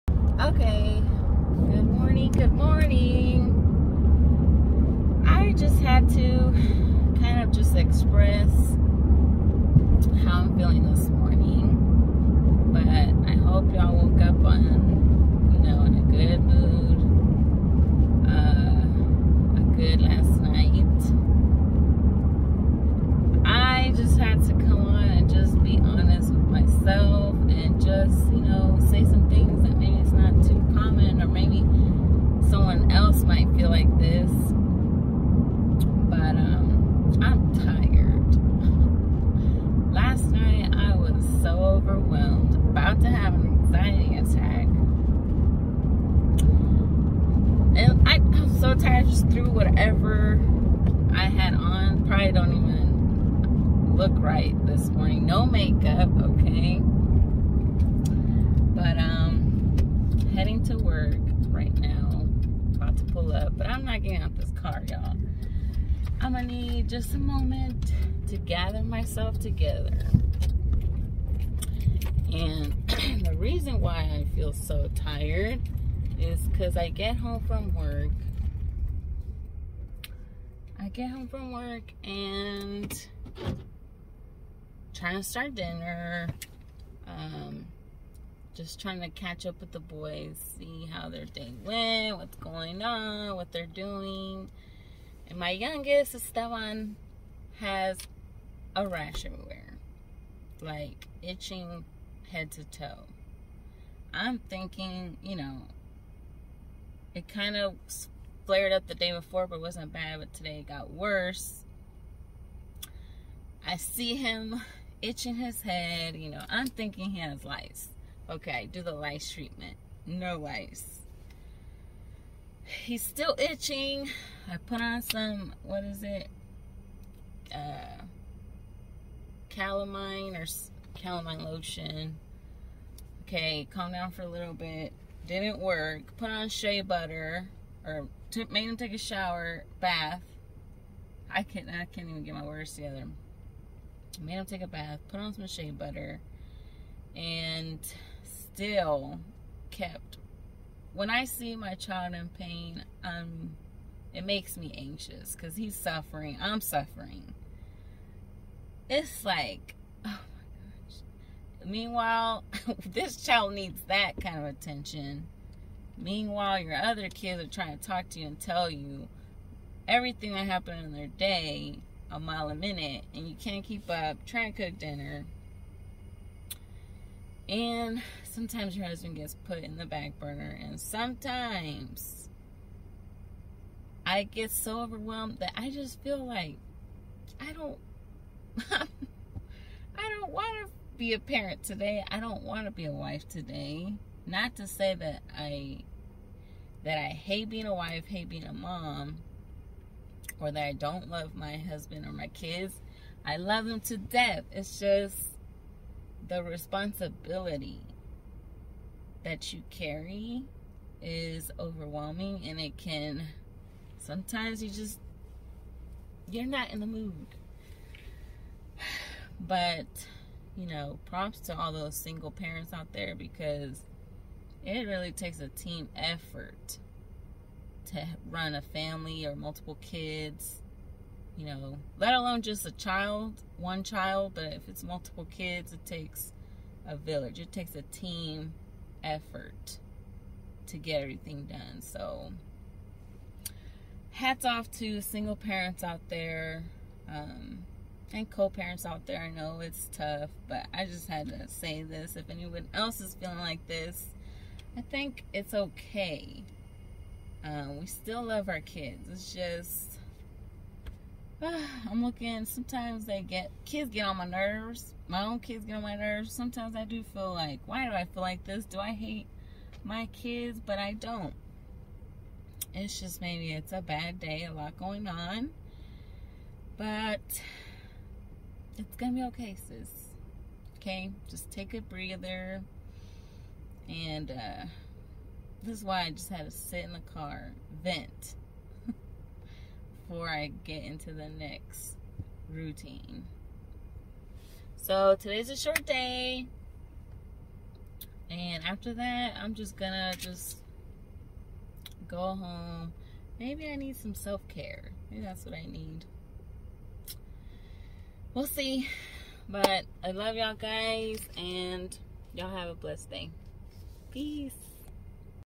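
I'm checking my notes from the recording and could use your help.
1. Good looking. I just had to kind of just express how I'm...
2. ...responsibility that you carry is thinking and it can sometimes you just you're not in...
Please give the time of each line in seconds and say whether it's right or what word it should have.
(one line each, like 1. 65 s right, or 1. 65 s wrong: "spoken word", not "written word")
1. 2 s wrong: "morning", not "looking"
2. 206 s wrong: "overwhelming", not "thinking".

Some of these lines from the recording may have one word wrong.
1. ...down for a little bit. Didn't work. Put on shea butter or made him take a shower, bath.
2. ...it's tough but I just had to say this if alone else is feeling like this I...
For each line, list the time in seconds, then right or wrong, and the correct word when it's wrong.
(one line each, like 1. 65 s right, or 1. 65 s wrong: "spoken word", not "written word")
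1. 133 s right
2. 249 s wrong: "anyone", not "alone".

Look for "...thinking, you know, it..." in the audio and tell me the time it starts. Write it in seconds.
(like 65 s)
104 s.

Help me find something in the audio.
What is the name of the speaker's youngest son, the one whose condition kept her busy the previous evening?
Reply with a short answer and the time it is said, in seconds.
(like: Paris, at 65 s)
Esteban, at 96 s.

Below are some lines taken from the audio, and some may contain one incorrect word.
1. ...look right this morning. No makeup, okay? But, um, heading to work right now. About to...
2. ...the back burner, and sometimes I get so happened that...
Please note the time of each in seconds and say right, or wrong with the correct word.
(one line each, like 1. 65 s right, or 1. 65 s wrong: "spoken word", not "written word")
1. 53 s right
2. 179 s wrong: "overwhelmed", not "happened".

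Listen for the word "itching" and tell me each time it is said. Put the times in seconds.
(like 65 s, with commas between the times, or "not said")
101 s, 115 s, 123 s.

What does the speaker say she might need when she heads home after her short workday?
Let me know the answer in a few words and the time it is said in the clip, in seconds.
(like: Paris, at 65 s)
Self-care, at 304 s.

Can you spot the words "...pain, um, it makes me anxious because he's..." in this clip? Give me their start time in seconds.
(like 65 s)
152 s.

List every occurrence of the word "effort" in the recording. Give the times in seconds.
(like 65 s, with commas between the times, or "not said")
225 s, 239 s.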